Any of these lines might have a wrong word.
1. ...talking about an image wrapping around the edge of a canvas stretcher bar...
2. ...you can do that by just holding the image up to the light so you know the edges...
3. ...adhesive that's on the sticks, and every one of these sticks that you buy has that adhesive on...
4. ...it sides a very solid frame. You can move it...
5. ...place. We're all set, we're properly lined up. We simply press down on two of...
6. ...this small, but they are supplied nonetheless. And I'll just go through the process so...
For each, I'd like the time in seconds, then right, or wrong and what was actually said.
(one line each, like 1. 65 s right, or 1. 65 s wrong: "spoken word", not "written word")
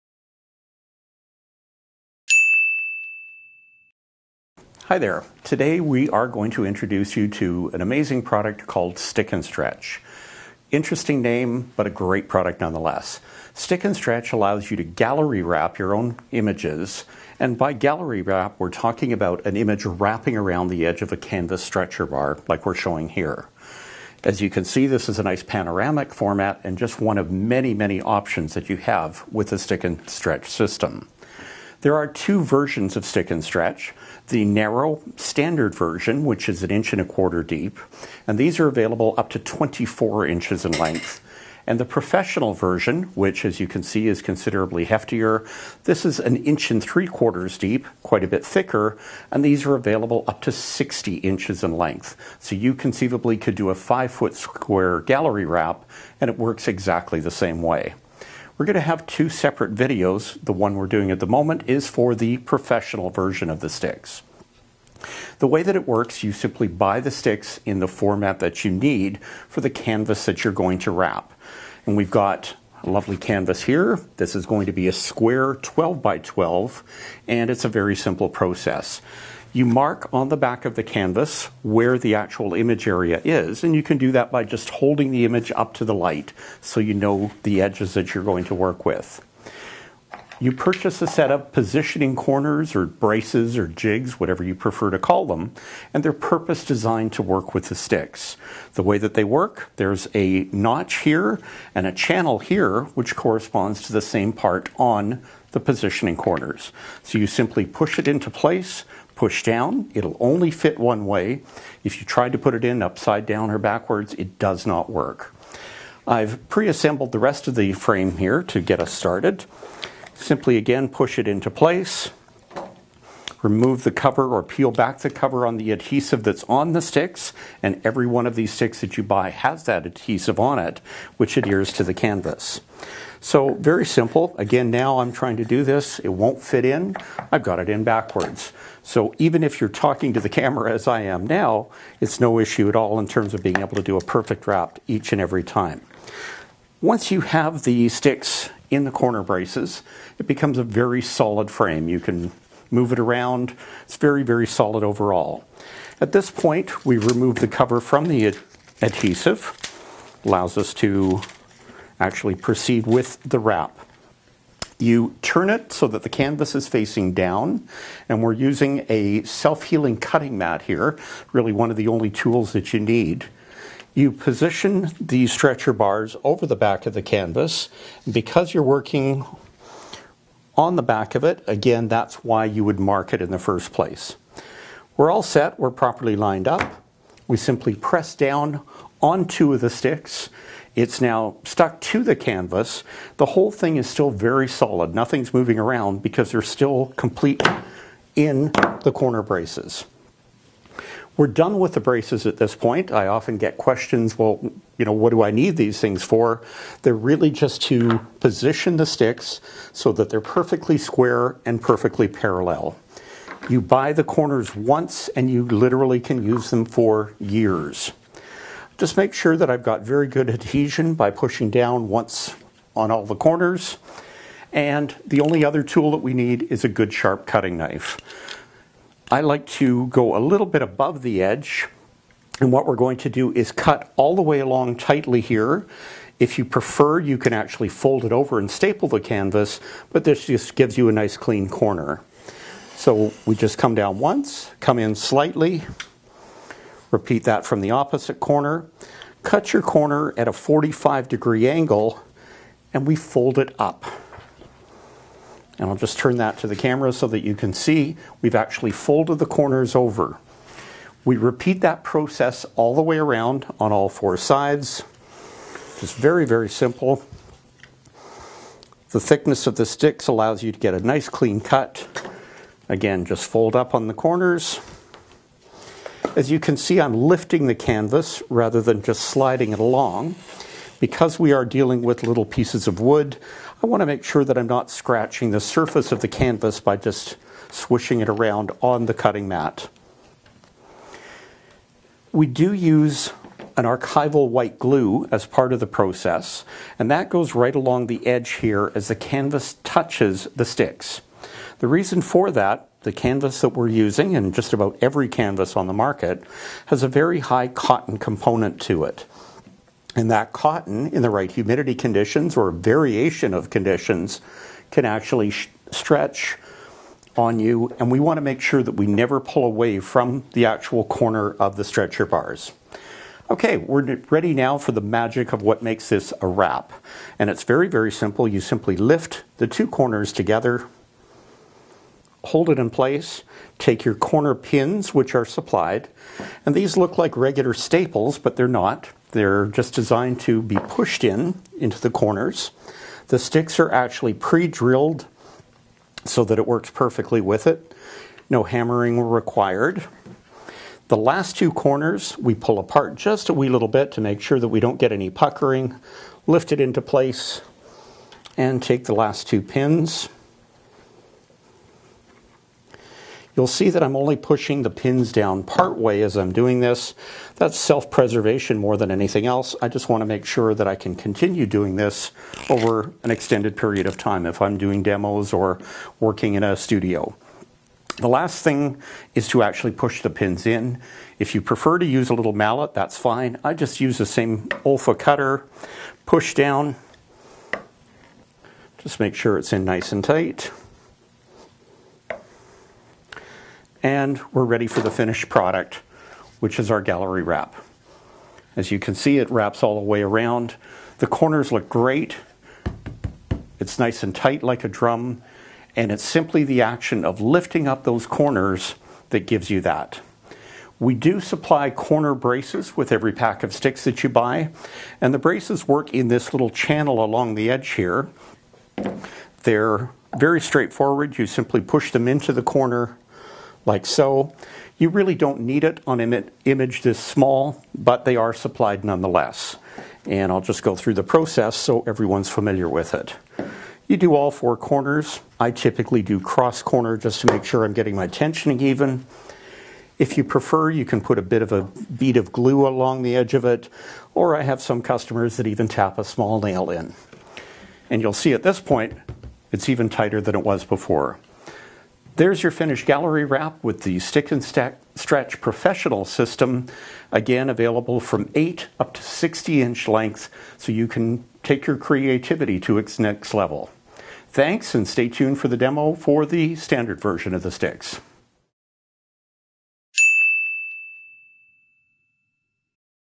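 1. 18 s right
2. 83 s right
3. 125 s right
4. 150 s wrong: "becomes", not "sides"
5. 183 s right
6. 426 s right.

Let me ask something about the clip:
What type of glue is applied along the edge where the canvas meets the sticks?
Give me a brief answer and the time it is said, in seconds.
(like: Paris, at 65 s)
archival white glue, at 293 s.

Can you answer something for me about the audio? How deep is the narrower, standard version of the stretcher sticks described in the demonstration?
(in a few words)
1 1/4 inches.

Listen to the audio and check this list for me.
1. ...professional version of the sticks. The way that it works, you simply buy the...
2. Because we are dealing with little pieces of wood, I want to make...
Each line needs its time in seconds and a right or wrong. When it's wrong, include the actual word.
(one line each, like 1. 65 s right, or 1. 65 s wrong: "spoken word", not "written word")
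1. 62 s right
2. 280 s right.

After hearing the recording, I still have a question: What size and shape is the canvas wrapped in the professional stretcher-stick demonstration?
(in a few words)
12 by 12 square.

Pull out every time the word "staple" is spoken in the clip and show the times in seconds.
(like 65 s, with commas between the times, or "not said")
238 s, 337 s.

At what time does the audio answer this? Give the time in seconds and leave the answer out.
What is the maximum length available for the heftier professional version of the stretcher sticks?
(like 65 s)
50 s.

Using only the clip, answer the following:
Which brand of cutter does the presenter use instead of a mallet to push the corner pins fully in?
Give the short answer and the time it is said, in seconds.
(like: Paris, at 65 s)
Olfa, at 384 s.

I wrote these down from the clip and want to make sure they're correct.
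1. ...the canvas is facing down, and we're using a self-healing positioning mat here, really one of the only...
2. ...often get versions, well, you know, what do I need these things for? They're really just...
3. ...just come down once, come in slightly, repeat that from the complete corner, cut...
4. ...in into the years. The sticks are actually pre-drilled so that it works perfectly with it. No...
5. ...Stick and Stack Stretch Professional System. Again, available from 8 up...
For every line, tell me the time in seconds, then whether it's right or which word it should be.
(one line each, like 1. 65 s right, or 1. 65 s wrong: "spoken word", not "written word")
1. 166 s wrong: "cutting", not "positioning"
2. 203 s wrong: "questions", not "versions"
3. 243 s wrong: "opposite", not "complete"
4. 341 s wrong: "corners", not "years"
5. 453 s right.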